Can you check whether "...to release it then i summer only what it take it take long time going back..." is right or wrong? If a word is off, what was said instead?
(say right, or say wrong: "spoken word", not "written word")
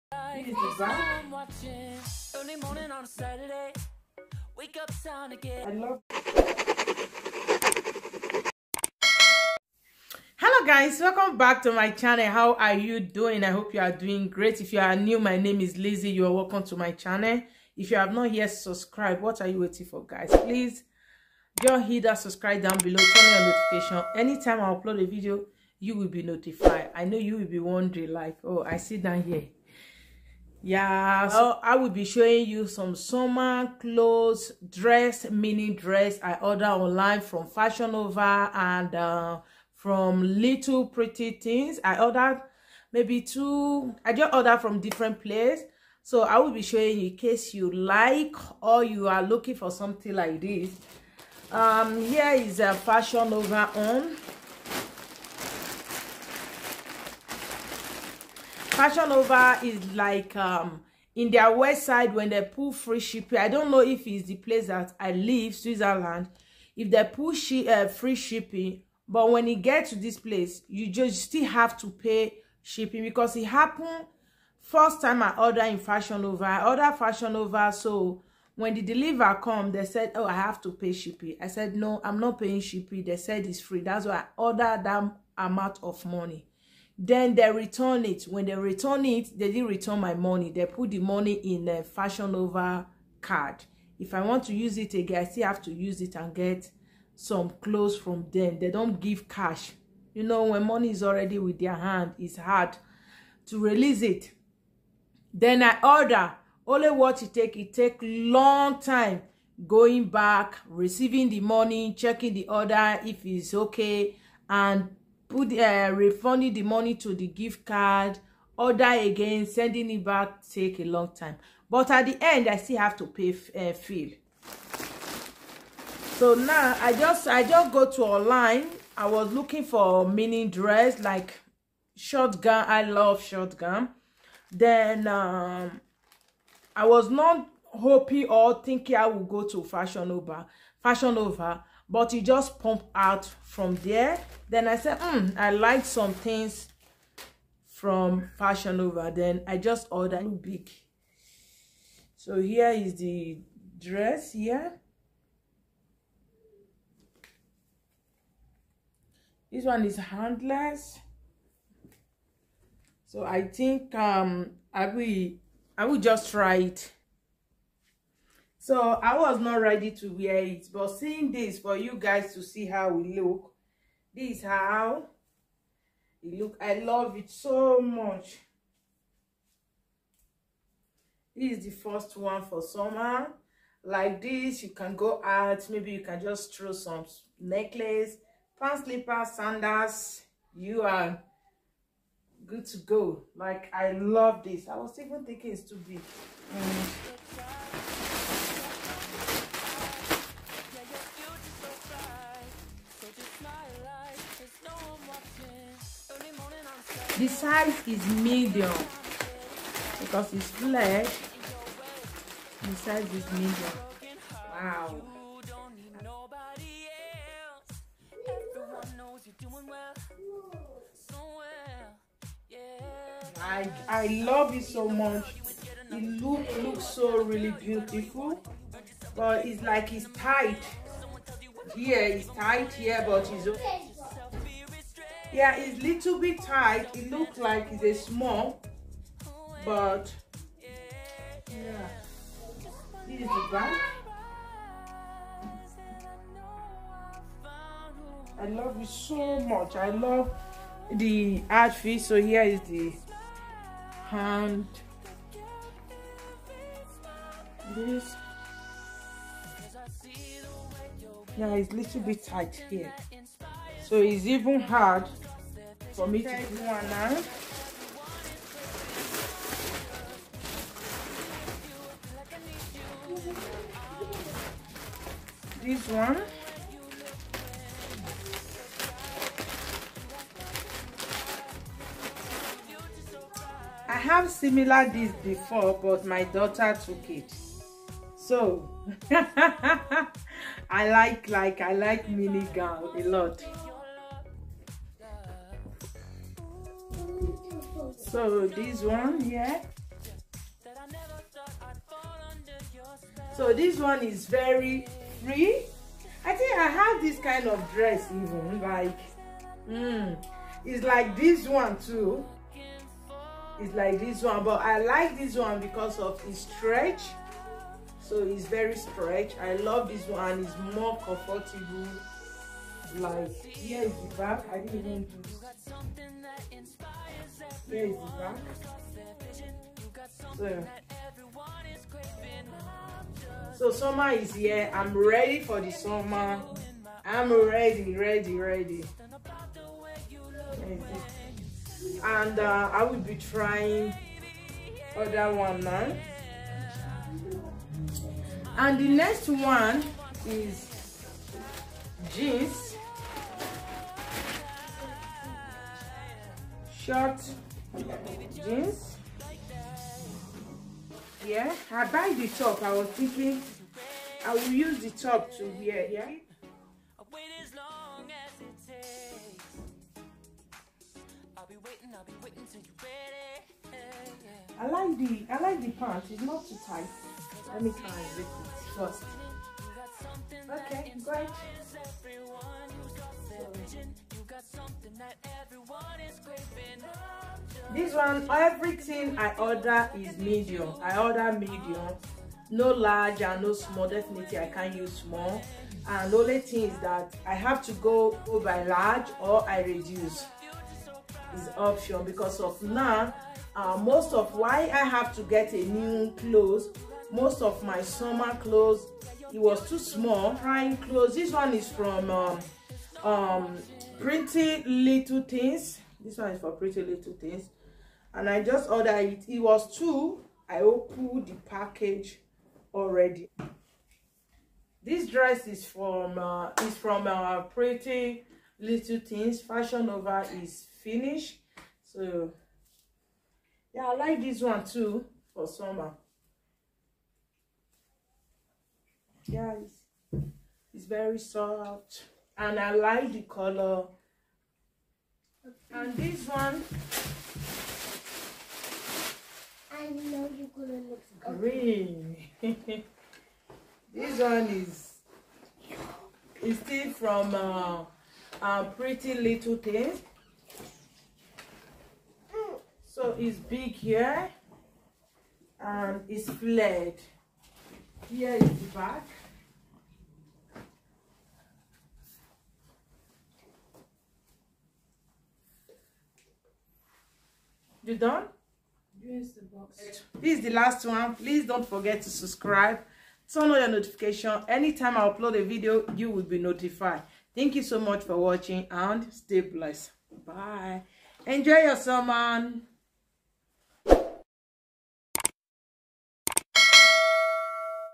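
wrong: "order", not "summer".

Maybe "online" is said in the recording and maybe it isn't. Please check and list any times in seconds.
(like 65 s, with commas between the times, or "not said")
36 s, 128 s.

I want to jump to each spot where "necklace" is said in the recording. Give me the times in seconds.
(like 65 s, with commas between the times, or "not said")
187 s.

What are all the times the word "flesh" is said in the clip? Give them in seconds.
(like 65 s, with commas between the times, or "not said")
210 s.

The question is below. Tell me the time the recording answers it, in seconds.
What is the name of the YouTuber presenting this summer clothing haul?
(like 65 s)
15 s.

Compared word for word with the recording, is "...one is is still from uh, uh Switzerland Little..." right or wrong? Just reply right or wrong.
wrong.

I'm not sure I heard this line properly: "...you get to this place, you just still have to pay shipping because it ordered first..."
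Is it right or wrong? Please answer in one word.
wrong.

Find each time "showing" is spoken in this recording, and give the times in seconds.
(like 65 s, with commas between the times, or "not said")
32 s, 46 s.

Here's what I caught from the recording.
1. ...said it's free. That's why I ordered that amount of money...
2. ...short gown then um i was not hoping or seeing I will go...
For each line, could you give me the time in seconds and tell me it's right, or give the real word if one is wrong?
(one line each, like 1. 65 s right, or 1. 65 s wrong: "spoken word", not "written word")
1. 83 s right
2. 133 s wrong: "thinking", not "seeing".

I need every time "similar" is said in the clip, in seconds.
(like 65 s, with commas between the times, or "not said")
284 s.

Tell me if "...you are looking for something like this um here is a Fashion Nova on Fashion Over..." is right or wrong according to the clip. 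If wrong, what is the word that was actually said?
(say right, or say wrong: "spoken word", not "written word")
right.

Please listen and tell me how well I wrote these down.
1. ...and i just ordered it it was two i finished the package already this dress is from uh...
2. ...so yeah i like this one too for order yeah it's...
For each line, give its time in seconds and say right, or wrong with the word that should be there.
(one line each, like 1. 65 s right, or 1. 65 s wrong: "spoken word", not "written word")
1. 418 s wrong: "opened", not "finished"
2. 431 s wrong: "summer", not "order".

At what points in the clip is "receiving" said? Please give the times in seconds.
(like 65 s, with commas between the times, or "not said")
110 s.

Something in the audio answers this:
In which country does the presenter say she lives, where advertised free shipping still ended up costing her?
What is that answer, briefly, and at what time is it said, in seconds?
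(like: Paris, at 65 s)
Switzerland, at 65 s.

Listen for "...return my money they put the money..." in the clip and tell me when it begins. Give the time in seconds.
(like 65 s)
89 s.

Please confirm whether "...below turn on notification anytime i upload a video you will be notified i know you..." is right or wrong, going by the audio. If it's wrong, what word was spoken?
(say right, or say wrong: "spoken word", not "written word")
right.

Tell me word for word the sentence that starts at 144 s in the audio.
Then I said, mm, I like some things from Fashion Nova.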